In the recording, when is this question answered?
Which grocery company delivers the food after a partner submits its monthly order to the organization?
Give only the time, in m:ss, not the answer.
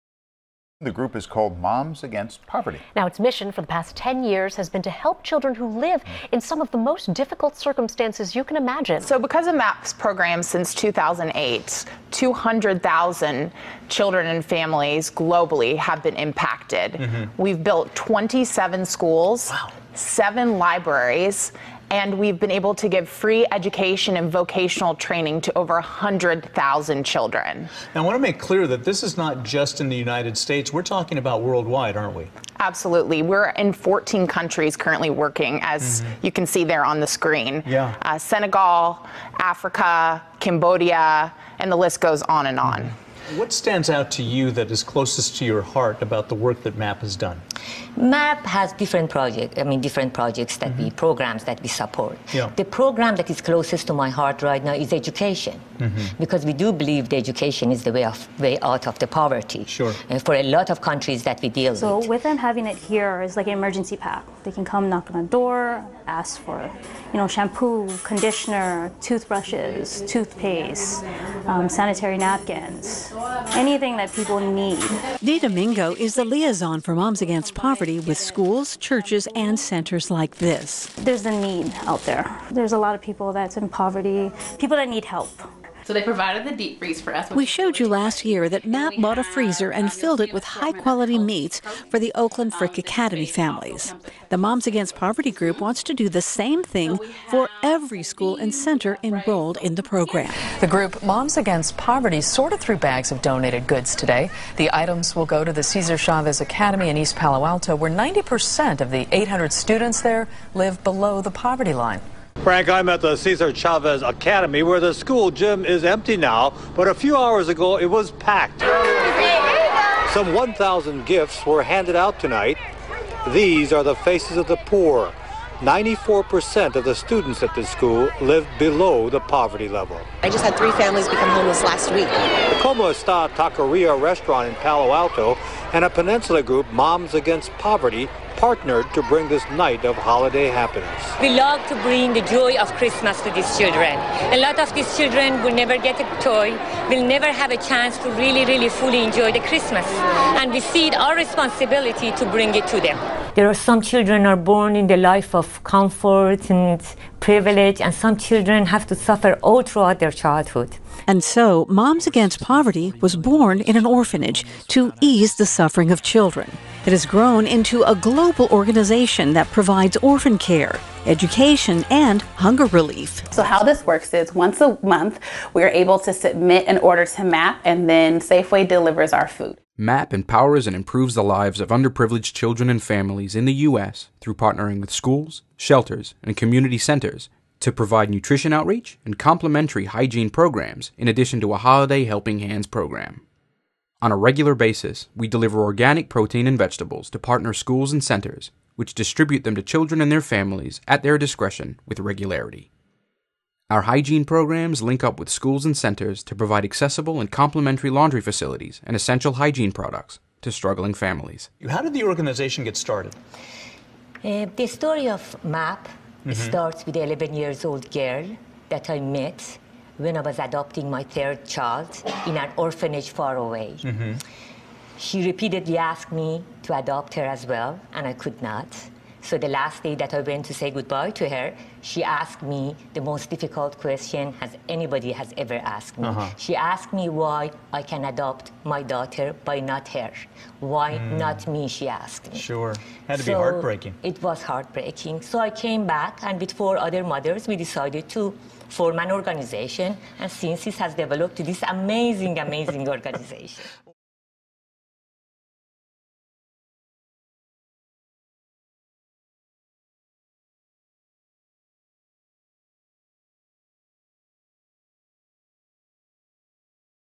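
2:58.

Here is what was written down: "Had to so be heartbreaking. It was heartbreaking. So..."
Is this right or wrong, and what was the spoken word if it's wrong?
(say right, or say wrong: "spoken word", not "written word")
right.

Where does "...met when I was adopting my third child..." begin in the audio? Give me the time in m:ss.
3:38.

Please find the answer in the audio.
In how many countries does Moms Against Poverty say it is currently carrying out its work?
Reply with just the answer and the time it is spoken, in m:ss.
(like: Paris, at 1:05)
14, at 0:33.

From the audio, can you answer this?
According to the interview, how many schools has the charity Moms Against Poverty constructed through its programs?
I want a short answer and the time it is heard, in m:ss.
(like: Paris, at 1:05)
27, at 0:17.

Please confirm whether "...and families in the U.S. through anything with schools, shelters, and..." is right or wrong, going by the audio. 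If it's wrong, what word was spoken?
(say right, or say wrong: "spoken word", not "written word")
wrong: "partnering", not "anything".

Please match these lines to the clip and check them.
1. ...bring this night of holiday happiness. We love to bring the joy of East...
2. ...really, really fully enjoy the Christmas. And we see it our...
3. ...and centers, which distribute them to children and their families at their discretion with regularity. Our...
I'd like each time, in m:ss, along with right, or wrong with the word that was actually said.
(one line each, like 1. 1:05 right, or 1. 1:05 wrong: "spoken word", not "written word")
1. 2:19 wrong: "Christmas", not "East"
2. 2:28 right
3. 3:17 right.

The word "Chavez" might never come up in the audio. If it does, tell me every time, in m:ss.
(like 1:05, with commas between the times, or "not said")
1:45, 1:53.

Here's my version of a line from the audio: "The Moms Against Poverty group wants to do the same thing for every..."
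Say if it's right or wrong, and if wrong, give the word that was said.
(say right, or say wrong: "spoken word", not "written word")
right.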